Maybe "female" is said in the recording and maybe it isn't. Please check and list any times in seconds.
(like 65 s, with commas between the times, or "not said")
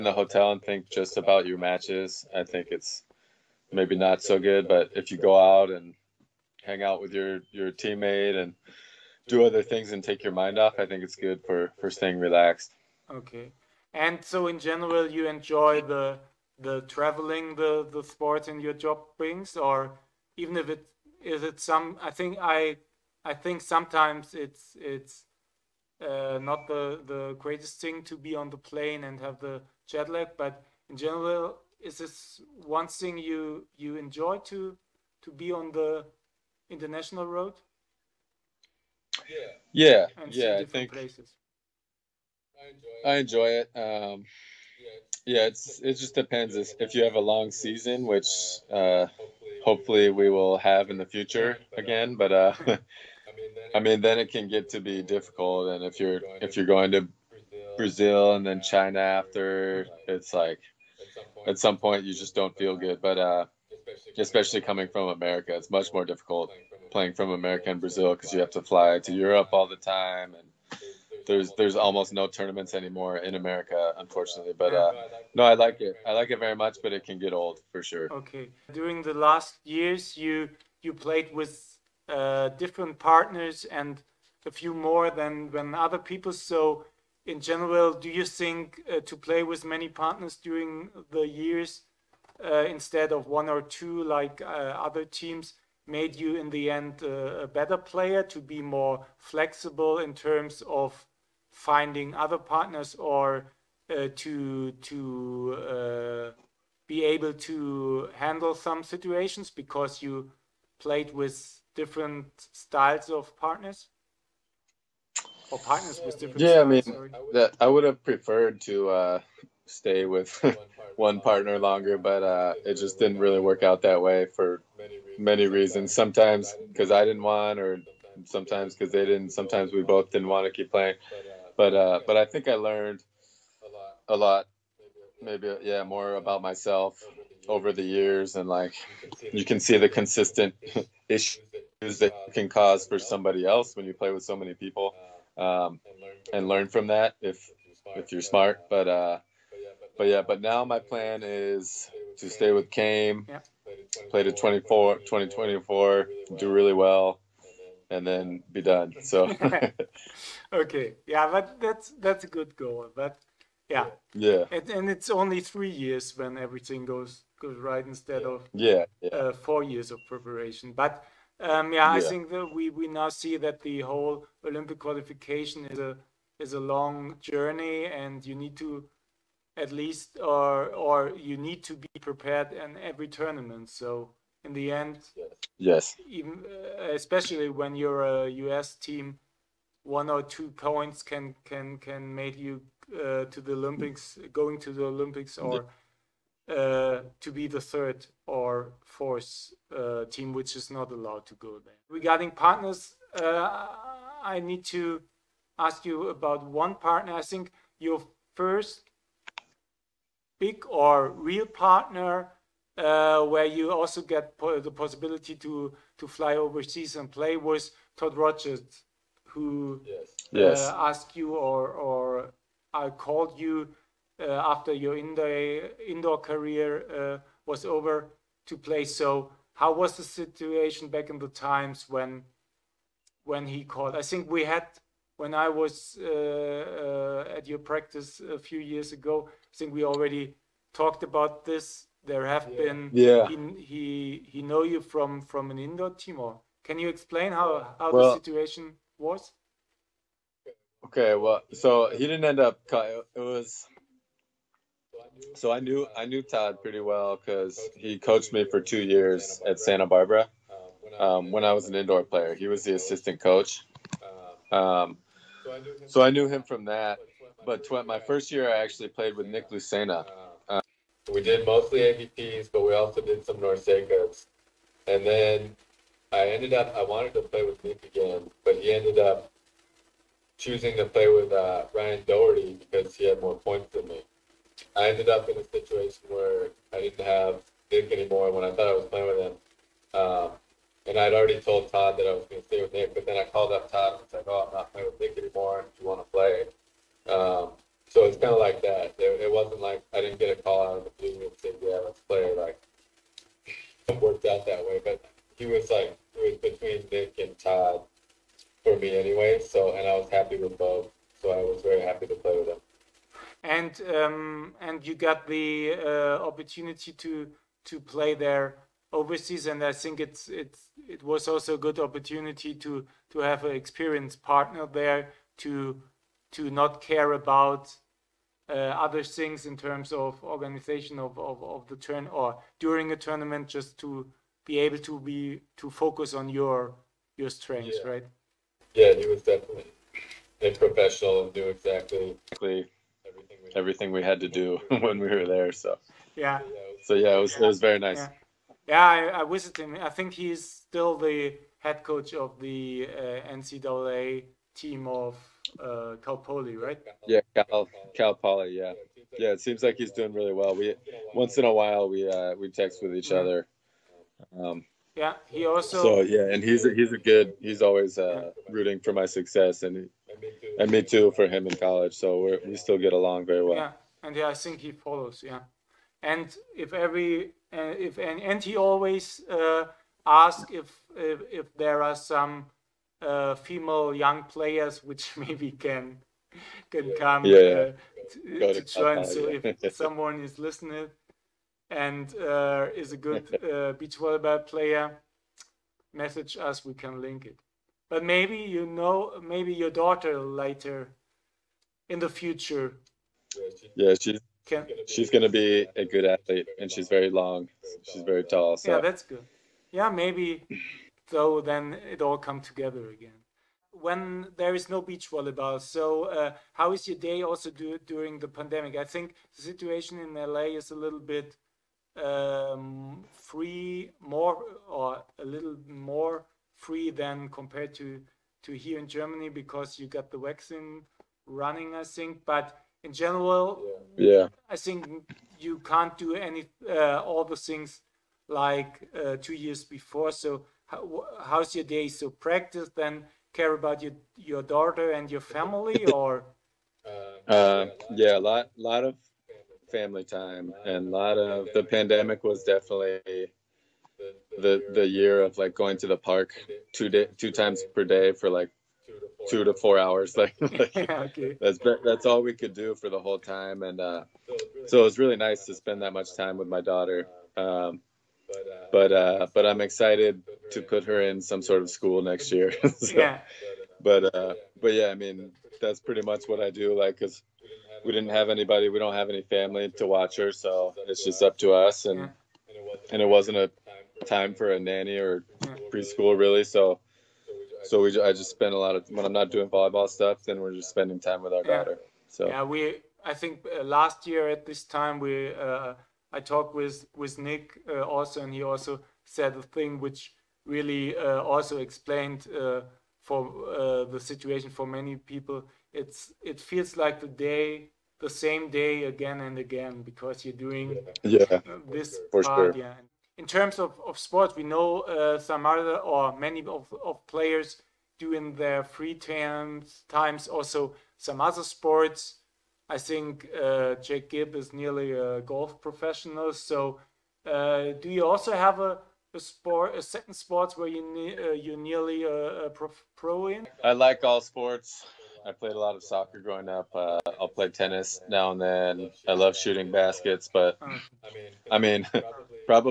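383 s.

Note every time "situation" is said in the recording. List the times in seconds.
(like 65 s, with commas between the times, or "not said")
108 s, 230 s, 248 s, 285 s, 419 s, 503 s.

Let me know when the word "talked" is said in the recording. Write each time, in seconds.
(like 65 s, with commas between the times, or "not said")
240 s, 496 s.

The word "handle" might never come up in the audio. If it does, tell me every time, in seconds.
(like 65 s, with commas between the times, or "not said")
108 s.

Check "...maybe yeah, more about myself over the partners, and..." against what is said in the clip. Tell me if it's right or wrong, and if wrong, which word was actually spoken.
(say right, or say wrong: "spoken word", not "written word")
wrong: "years", not "partners".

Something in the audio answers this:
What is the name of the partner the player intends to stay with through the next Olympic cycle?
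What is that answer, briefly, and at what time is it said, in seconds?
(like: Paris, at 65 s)
Chaim, at 152 s.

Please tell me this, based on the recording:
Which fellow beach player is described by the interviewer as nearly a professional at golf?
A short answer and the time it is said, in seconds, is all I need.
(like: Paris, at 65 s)
Jake Gibb, at 523 s.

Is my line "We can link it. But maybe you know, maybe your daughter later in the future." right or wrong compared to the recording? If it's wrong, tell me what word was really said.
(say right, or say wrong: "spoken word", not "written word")
right.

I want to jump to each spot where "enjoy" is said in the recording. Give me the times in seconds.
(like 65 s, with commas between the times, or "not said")
15 s, 33 s, 43 s.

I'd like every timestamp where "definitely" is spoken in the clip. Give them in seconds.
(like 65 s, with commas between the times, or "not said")
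339 s, 452 s.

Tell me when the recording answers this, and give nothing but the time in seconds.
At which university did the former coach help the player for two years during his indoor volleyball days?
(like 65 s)
259 s.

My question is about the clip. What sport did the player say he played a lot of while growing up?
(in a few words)
Soccer.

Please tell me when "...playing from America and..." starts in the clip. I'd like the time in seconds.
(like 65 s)
66 s.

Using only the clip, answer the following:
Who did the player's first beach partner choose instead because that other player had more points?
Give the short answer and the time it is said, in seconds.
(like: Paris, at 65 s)
Ryan Doherty, at 281 s.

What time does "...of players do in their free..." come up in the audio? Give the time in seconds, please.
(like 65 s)
516 s.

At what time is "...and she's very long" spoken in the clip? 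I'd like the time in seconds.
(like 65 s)
406 s.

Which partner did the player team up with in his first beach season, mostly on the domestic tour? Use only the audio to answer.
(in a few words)
Nick Lucena.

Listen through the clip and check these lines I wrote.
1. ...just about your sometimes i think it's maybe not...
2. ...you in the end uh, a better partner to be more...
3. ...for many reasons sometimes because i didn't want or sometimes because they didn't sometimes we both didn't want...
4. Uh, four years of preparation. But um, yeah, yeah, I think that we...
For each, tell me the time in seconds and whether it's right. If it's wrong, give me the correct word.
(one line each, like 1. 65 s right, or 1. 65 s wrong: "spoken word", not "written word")
1. 0 s wrong: "matches", not "sometimes"
2. 96 s wrong: "player", not "partner"
3. 124 s right
4. 169 s right.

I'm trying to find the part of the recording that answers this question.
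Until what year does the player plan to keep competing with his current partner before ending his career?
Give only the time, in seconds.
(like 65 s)
154 s.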